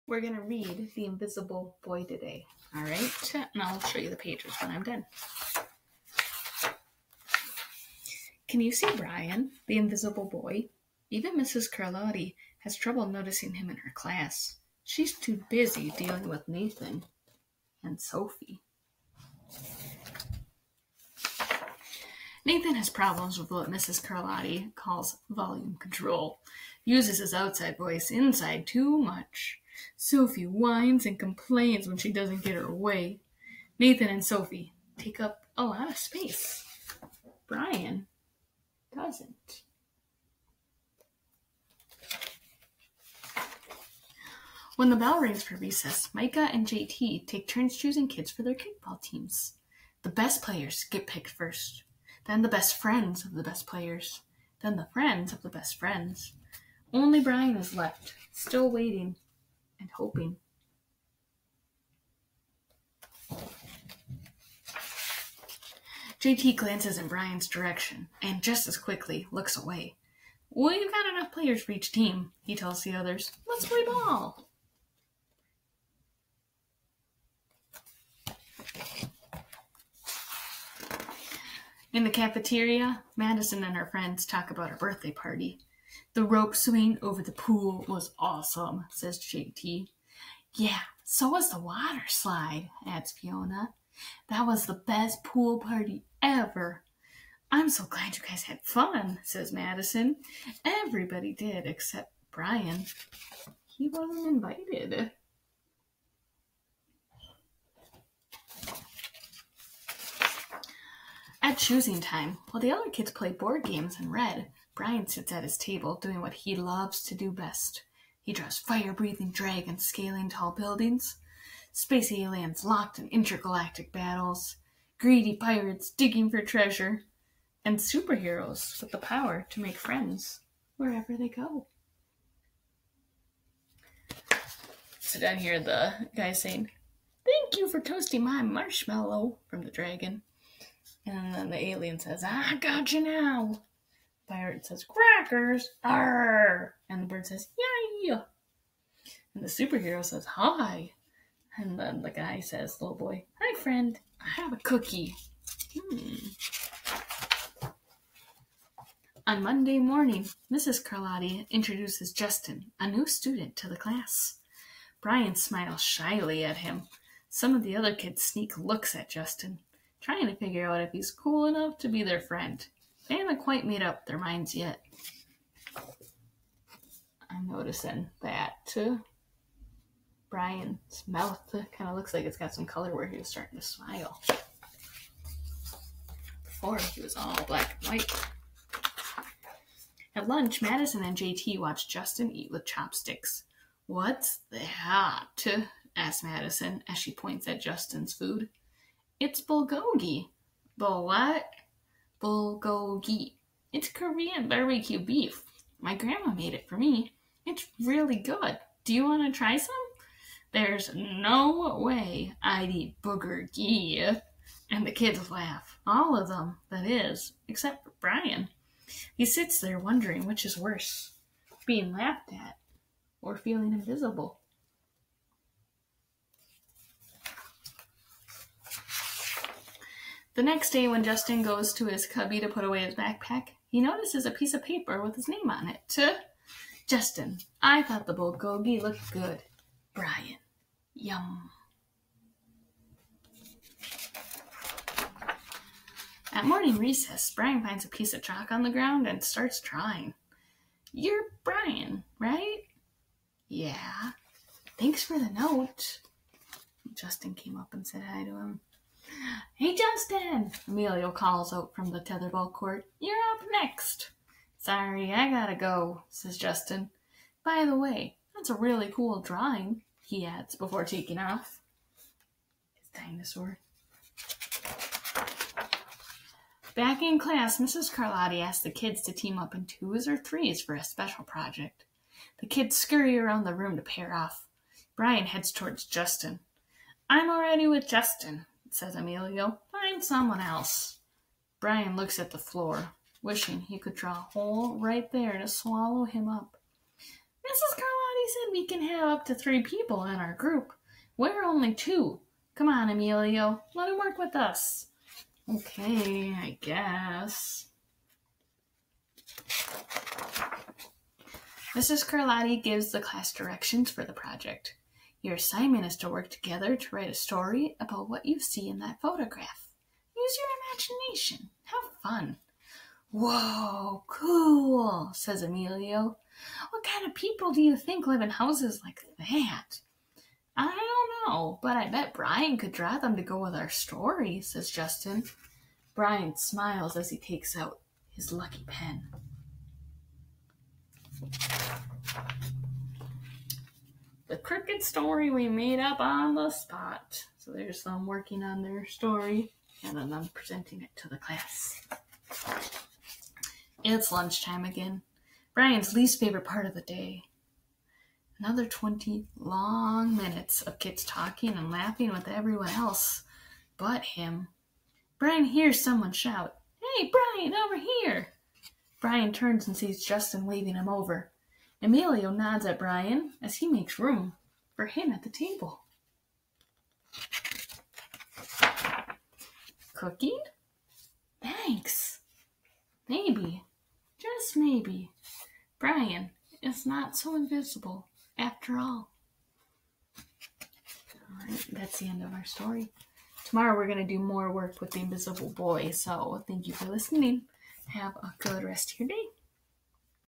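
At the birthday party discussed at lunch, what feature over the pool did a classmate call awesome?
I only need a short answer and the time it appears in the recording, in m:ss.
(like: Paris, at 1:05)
rope swing, at 1:26.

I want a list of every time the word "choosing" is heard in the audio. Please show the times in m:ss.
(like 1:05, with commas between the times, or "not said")
0:47, 1:51.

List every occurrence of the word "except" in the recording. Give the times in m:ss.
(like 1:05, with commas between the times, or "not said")
1:41, 3:37.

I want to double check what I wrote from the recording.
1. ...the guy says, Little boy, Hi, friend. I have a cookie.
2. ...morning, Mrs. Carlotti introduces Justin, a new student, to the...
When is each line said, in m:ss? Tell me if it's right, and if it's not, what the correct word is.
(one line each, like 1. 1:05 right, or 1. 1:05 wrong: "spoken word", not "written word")
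1. 2:32 right
2. 2:39 right.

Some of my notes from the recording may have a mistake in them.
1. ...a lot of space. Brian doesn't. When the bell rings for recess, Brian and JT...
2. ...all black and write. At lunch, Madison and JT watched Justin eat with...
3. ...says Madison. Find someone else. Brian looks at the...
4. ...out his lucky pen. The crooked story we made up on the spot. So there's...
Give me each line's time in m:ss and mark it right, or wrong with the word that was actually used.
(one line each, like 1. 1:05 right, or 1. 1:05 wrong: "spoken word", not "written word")
1. 0:35 wrong: "Micah", not "Brian"
2. 3:07 wrong: "white", not "write"
3. 4:48 wrong: "Emilio", not "Madison"
4. 5:37 right.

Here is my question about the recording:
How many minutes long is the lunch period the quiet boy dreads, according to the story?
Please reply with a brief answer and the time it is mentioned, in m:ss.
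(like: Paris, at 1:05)
20, at 5:58.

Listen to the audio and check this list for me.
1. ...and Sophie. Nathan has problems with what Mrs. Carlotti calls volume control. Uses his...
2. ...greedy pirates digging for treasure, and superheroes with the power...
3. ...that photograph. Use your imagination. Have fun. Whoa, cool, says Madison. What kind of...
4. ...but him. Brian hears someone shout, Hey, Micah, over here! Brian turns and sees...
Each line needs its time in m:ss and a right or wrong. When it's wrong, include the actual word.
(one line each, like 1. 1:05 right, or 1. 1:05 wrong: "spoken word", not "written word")
1. 0:17 right
2. 2:04 right
3. 5:18 wrong: "Emilio", not "Madison"
4. 6:03 wrong: "Brian", not "Micah".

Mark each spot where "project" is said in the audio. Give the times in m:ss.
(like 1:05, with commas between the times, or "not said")
4:41, 5:14.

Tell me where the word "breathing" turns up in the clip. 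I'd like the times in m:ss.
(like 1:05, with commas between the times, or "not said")
1:58.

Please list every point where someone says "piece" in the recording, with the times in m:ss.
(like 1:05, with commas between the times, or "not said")
3:54, 4:07.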